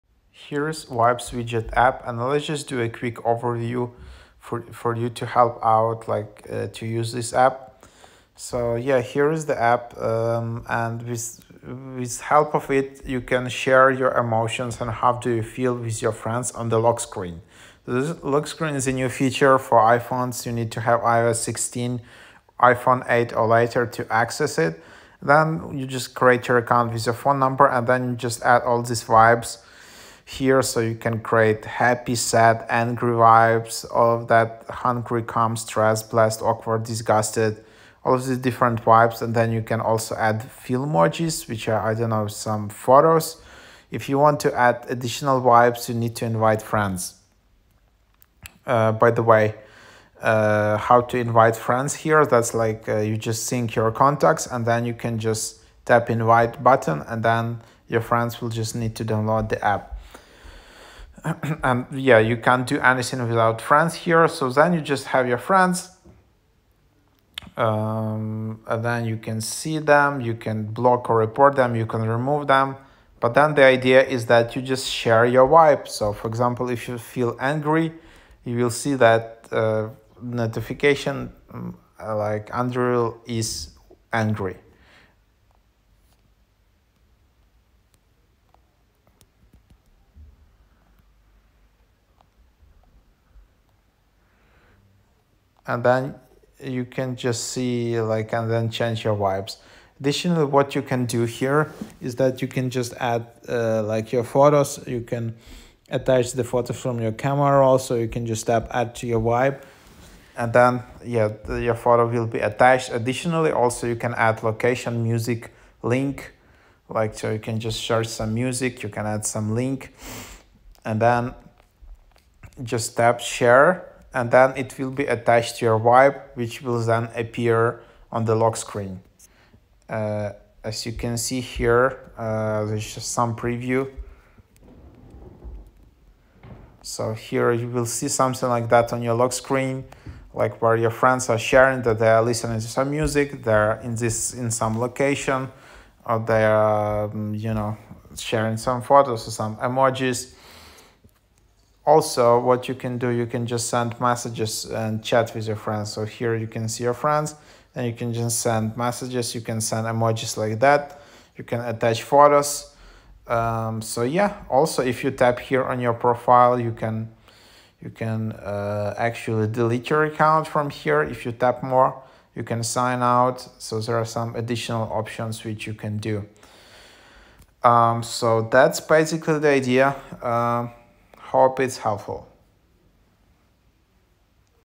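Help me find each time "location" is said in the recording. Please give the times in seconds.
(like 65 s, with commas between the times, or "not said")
114 s, 144 s.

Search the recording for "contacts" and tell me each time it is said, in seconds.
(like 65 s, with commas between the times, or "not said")
53 s.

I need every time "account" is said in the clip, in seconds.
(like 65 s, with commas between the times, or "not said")
26 s, 170 s.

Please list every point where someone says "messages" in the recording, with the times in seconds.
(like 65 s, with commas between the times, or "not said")
153 s, 158 s.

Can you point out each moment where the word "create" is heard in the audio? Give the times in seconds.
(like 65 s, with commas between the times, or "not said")
26 s, 31 s.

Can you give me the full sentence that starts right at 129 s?
Uh, as you can see here, uh, there's some preview.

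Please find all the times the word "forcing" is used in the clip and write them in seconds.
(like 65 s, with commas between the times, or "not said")
not said.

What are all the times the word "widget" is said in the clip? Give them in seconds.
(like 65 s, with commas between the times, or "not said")
1 s.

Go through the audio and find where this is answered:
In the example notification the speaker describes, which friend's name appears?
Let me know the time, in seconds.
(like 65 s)
82 s.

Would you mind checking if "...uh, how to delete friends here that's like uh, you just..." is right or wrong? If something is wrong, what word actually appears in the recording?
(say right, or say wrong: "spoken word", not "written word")
wrong: "invite", not "delete".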